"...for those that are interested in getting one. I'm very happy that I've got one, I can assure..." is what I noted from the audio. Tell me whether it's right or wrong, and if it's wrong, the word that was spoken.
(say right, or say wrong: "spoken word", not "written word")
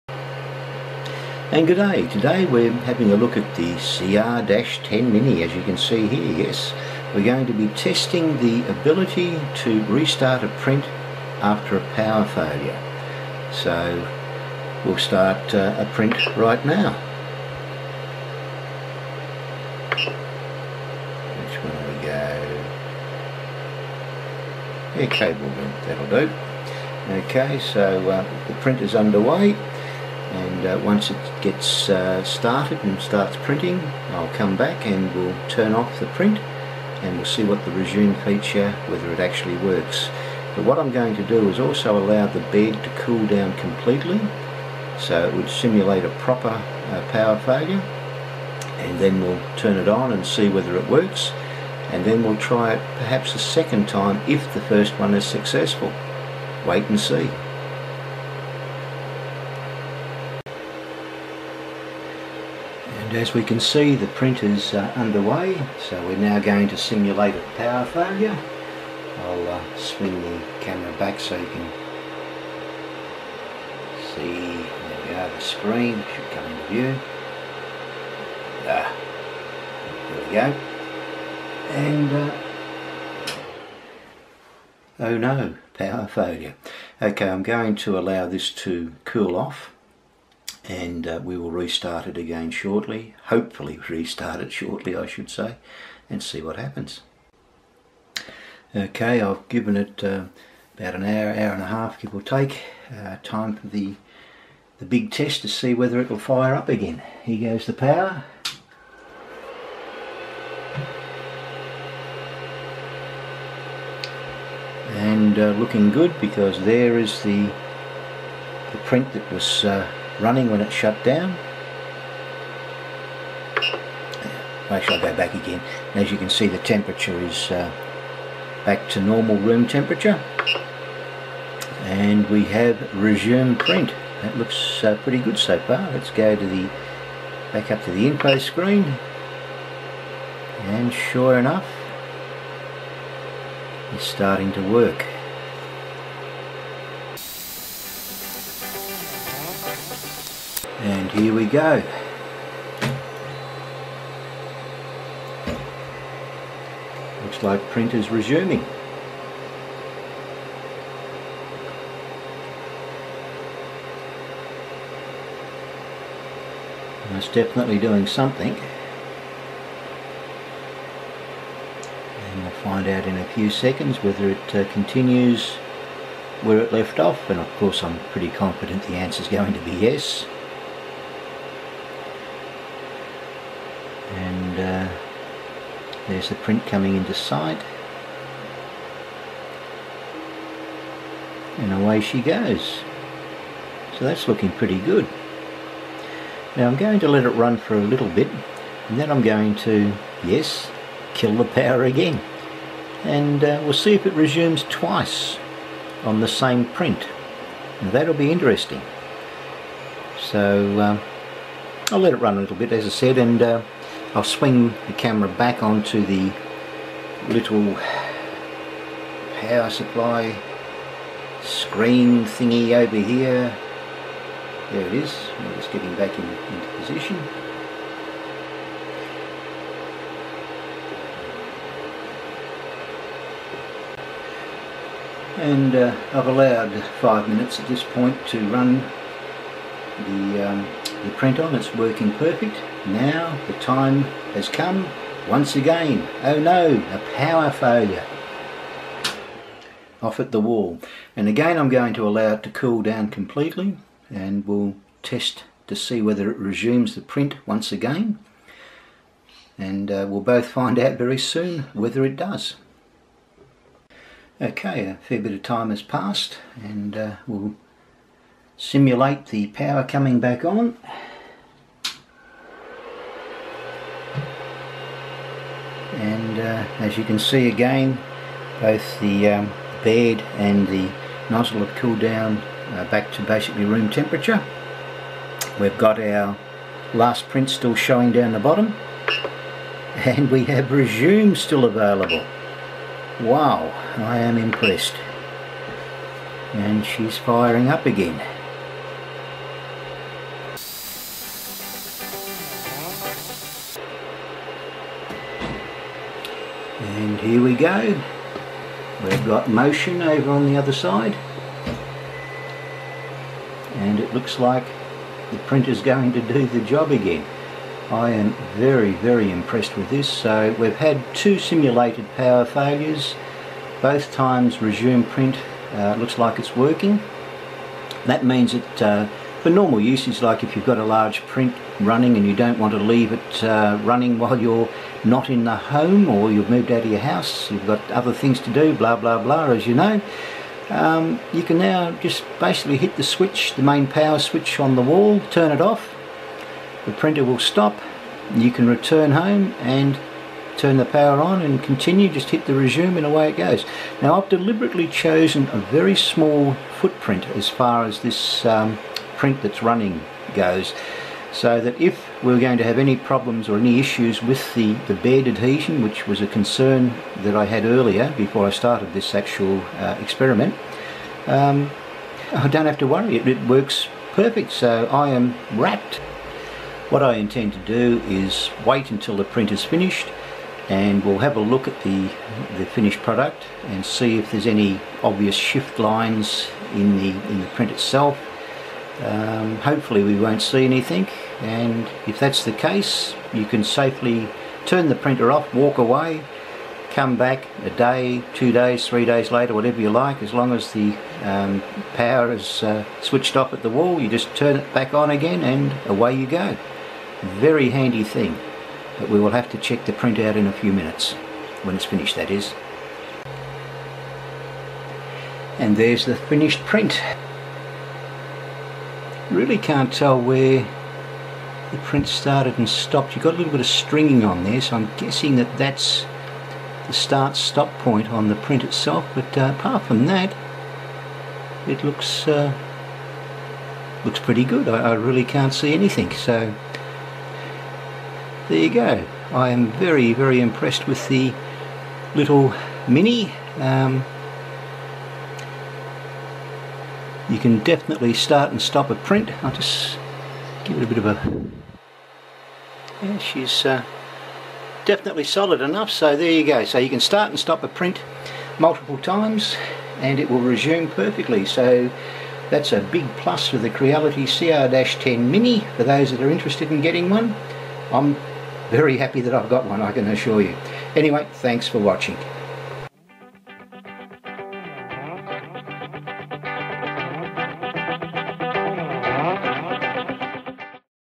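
right.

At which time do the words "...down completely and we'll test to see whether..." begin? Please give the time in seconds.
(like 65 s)
252 s.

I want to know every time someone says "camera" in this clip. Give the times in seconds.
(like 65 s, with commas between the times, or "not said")
70 s, 214 s.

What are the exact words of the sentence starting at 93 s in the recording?
Hopefully, restart it shortly, I should say, and see what happens.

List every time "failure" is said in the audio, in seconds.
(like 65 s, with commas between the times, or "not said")
12 s, 47 s, 67 s, 86 s, 247 s, 322 s.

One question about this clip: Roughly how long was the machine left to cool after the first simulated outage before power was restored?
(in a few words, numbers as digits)
an hour, hour and a half.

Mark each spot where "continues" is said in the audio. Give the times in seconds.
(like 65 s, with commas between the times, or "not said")
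174 s, 351 s.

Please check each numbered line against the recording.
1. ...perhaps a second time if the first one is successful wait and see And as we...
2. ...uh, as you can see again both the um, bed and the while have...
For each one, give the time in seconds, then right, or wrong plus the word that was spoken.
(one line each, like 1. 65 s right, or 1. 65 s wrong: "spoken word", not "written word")
1. 52 s right
2. 276 s wrong: "nozzle", not "while".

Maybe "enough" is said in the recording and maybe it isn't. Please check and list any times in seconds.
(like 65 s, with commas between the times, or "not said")
141 s, 455 s.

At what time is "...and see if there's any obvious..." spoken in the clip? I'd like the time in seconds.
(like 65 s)
383 s.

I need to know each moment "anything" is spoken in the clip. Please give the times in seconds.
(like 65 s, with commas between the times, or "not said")
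390 s, 435 s.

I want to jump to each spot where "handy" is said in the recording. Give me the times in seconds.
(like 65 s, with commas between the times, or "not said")
407 s.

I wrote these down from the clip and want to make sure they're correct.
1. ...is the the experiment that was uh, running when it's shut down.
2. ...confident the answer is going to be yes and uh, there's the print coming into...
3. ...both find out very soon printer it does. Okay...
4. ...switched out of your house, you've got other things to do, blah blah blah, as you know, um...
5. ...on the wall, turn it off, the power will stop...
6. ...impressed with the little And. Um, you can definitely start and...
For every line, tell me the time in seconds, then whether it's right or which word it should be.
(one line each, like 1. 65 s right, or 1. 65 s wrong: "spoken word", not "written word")
1. 116 s wrong: "print", not "experiment"
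2. 178 s right
3. 260 s wrong: "whether", not "printer"
4. 336 s wrong: "moved", not "switched"
5. 344 s wrong: "printer", not "power"
6. 440 s wrong: "Mini", not "And".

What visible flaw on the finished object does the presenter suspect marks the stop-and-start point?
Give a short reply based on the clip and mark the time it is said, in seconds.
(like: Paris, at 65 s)
stringing, at 423 s.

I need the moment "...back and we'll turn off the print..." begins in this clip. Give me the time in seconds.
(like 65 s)
34 s.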